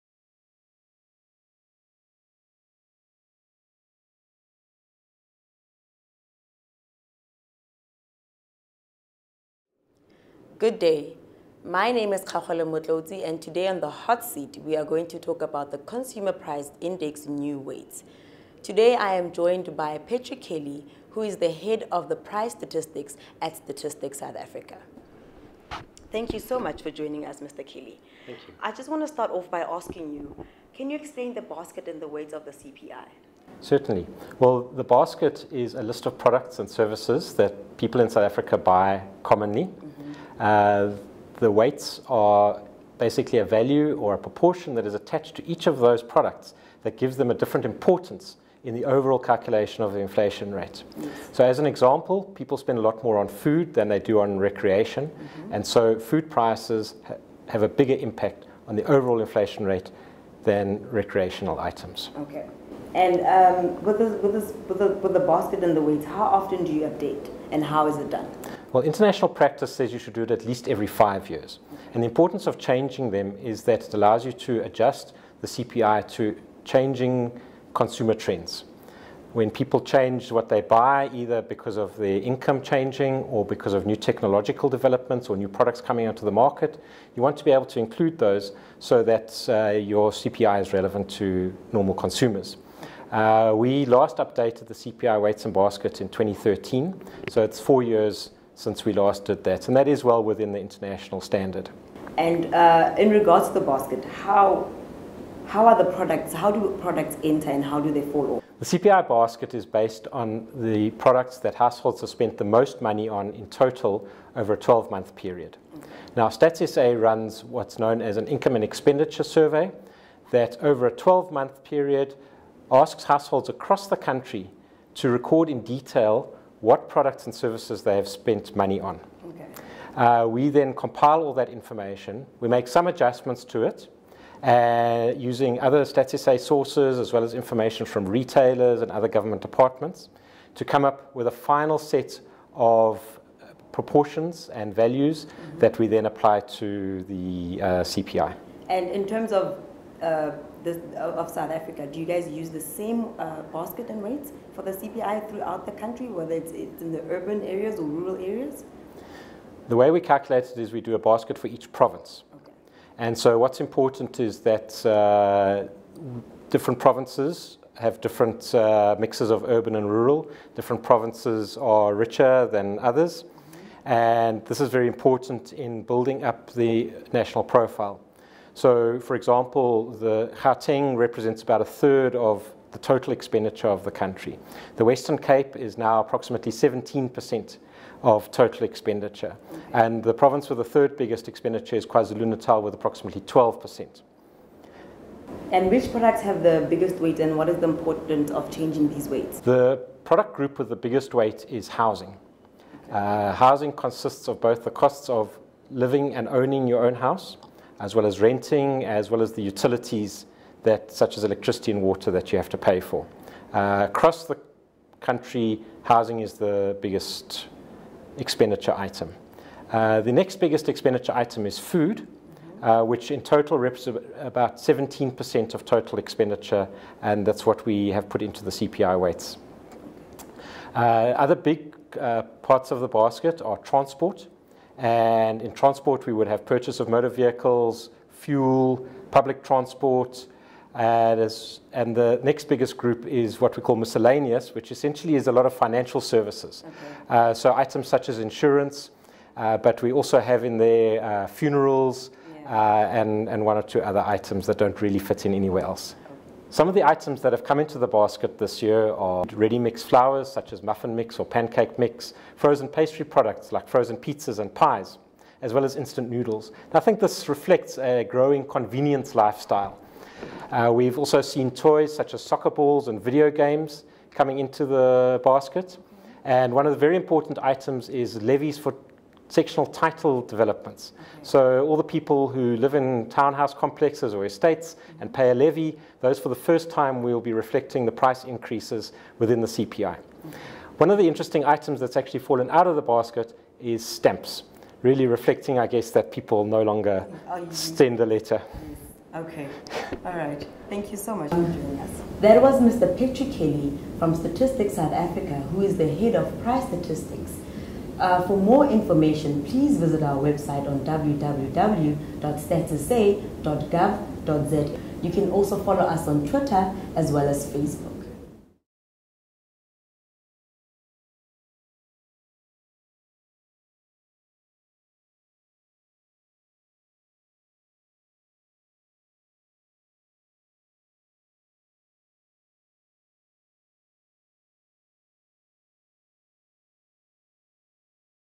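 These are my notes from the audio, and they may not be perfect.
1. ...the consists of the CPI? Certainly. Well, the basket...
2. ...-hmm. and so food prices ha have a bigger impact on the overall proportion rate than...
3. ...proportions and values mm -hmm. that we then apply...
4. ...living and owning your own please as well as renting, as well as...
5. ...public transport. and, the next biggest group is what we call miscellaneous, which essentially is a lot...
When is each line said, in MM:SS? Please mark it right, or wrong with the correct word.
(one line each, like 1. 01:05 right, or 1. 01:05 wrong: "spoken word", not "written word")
1. 00:31 wrong: "weights", not "consists"
2. 00:55 wrong: "inflation", not "proportion"
3. 02:23 right
4. 03:25 wrong: "house", not "please"
5. 03:59 right.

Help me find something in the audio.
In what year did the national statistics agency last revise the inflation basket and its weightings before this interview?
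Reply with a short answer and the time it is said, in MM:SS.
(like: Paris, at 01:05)
2013, at 01:36.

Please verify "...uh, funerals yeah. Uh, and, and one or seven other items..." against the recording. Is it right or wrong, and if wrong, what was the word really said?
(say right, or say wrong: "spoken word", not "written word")
wrong: "two", not "seven".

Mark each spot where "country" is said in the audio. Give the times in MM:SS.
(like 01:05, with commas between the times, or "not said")
02:03, 02:35, 03:03, 03:35.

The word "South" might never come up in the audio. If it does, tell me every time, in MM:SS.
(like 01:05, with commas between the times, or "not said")
00:24, 00:38, 02:31, 05:04.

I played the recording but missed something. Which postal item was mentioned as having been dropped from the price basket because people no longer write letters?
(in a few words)
Stamps.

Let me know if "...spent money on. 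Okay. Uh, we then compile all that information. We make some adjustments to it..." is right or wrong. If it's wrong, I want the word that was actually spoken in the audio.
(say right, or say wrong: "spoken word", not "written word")
right.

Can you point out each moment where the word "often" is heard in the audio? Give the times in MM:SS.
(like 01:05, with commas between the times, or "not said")
01:06.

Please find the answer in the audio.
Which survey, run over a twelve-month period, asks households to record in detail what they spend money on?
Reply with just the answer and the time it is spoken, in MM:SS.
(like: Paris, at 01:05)
Income and expenditure survey, at 01:58.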